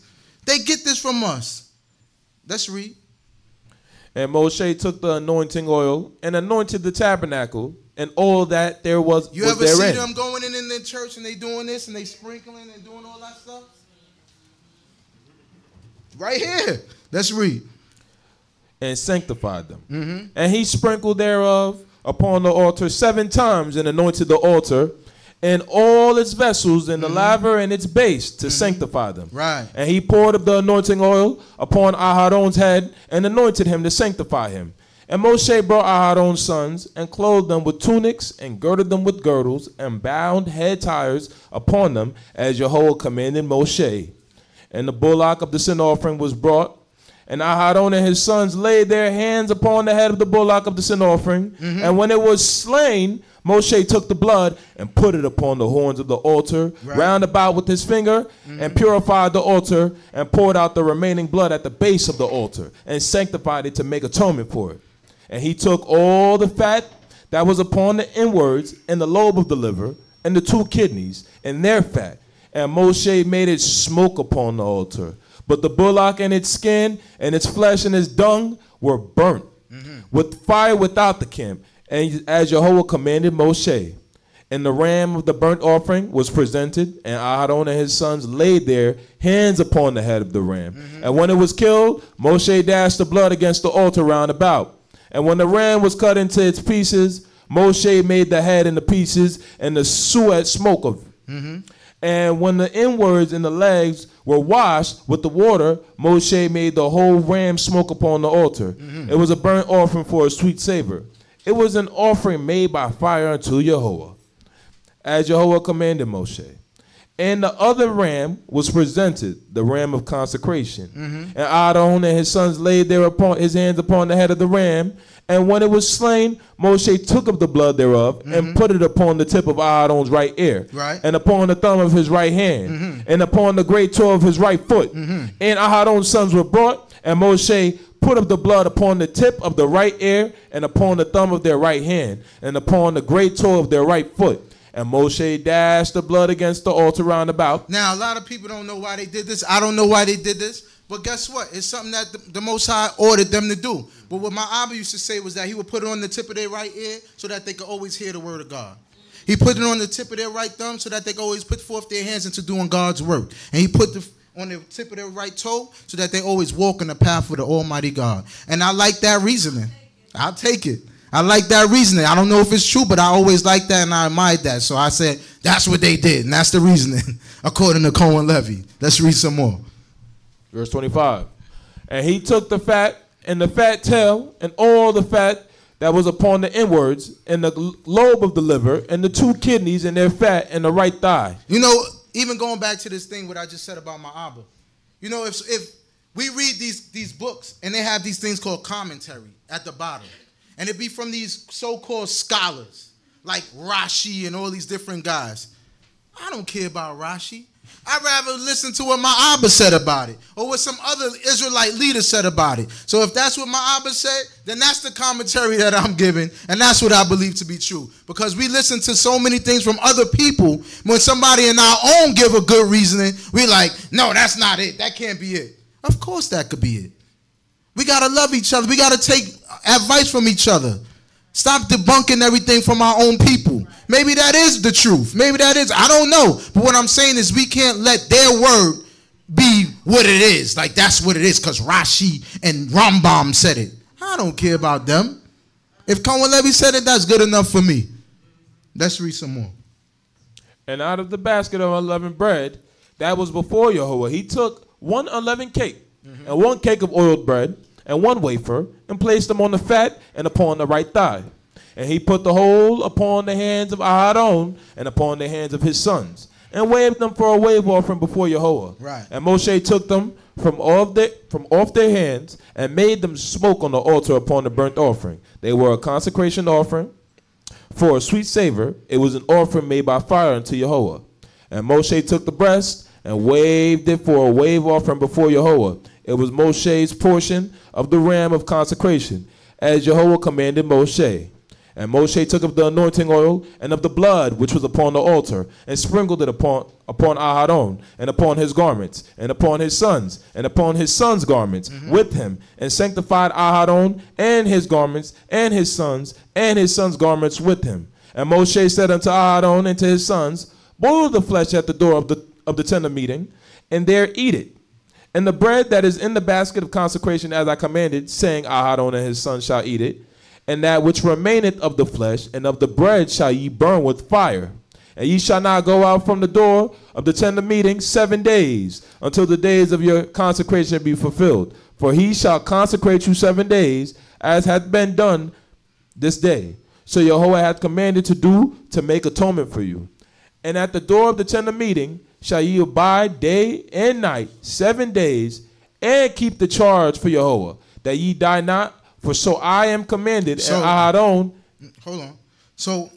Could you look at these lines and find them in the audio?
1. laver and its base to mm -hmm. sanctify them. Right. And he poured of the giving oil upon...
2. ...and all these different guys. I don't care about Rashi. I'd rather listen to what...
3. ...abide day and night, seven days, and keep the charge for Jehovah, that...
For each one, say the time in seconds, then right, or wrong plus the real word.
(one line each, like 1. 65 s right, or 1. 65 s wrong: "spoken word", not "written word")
1. 27 s wrong: "anointing", not "giving"
2. 204 s right
3. 342 s right.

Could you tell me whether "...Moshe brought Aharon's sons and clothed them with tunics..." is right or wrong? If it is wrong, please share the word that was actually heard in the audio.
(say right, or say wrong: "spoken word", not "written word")
right.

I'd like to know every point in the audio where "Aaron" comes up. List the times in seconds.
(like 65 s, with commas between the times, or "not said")
87 s, 129 s, 135 s, 263 s.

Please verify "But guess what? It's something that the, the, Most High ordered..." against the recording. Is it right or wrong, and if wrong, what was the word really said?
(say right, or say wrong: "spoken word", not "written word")
right.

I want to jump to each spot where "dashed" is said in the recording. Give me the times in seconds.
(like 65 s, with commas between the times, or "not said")
92 s, 145 s.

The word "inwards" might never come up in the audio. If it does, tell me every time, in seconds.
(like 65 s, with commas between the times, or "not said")
68 s, 102 s, 186 s.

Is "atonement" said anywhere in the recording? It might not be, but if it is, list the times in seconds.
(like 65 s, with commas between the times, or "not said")
64 s, 339 s.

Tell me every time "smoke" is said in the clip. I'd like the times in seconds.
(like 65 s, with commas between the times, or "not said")
73 s, 100 s, 107 s, 273 s.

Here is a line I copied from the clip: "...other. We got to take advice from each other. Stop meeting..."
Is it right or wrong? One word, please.
wrong.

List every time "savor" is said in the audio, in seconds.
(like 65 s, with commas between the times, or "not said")
110 s, 278 s.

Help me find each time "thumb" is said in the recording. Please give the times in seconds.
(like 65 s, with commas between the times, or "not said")
131 s, 141 s, 160 s.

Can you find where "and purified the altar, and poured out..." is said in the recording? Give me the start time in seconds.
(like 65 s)
58 s.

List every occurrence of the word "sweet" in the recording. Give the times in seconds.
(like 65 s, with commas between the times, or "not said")
110 s, 278 s.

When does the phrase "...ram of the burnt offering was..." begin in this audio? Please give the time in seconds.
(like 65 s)
84 s.